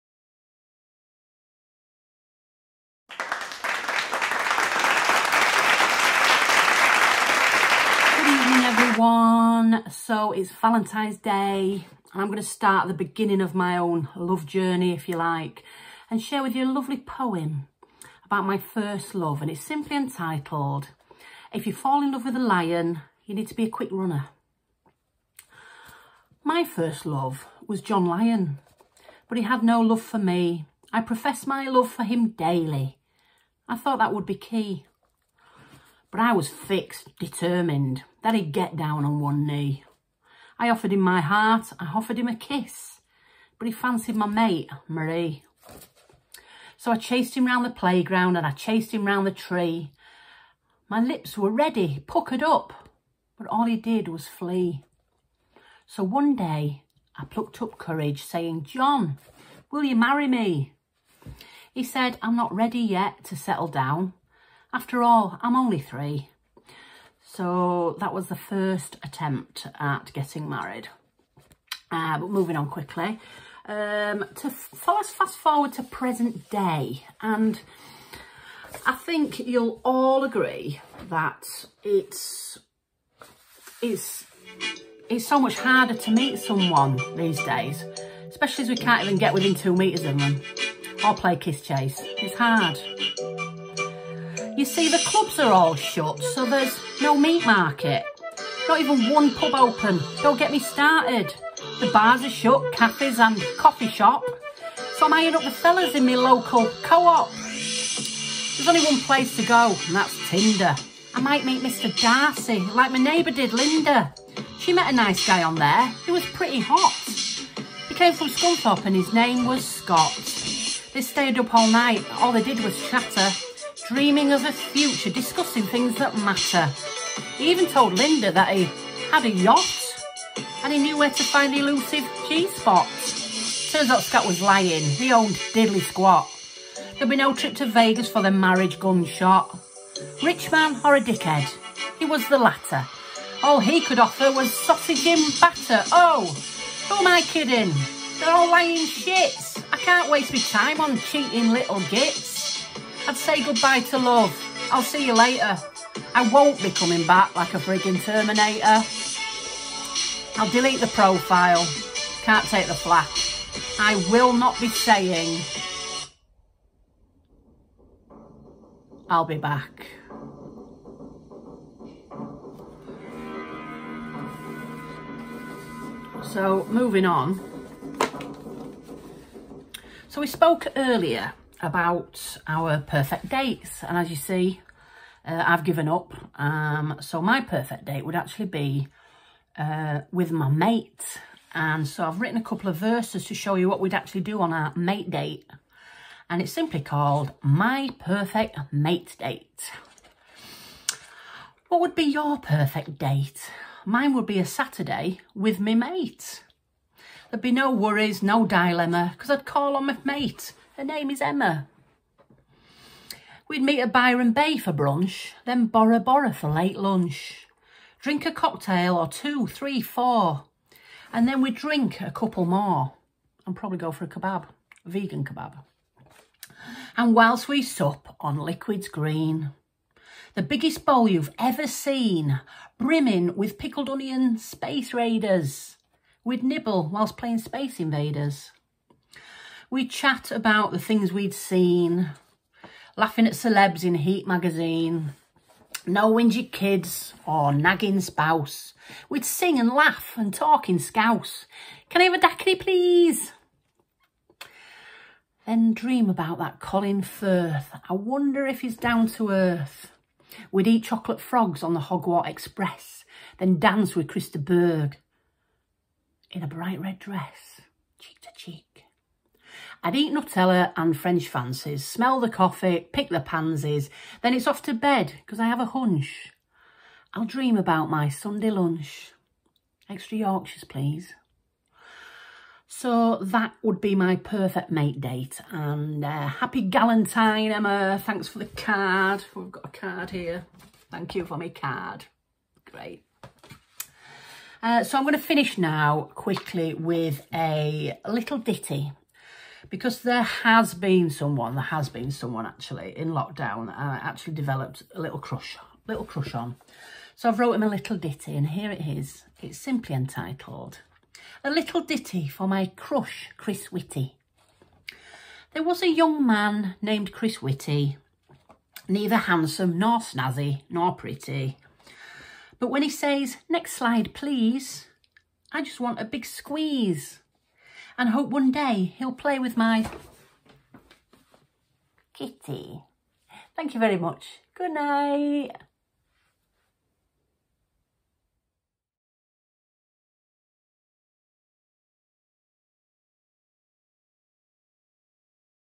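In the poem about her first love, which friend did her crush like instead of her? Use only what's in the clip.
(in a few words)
Marie.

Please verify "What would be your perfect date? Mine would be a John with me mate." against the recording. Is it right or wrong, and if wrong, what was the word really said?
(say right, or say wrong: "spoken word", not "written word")
wrong: "Saturday", not "John".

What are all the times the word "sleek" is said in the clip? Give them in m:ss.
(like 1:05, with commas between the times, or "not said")
not said.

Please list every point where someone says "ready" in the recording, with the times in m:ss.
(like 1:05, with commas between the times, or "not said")
0:51, 1:02.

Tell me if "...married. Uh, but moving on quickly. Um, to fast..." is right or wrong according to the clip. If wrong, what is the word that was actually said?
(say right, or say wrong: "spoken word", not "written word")
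right.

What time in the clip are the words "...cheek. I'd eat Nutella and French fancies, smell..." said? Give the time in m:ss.
4:28.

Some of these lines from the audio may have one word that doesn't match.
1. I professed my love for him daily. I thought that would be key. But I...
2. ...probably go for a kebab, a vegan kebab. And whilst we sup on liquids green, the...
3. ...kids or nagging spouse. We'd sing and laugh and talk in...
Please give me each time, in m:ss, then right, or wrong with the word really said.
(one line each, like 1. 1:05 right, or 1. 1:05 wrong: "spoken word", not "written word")
1. 0:30 right
2. 3:43 right
3. 4:06 right.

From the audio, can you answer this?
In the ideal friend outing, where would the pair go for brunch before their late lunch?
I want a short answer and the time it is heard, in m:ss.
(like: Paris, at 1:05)
Byron Bay, at 3:33.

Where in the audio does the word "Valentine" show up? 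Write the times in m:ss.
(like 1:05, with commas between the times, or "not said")
0:10.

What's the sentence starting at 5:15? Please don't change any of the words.
There was a young man named Chris Whitty, neither handsome nor snazzy nor pretty.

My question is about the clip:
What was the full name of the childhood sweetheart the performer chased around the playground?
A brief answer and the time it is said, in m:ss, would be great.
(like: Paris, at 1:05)
John Lyon, at 0:27.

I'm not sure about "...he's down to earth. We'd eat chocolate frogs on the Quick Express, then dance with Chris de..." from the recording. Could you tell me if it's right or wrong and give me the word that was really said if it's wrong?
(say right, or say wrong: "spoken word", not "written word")
wrong: "Hogwarts", not "Quick".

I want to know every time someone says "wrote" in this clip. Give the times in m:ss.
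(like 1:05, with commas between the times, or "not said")
5:07.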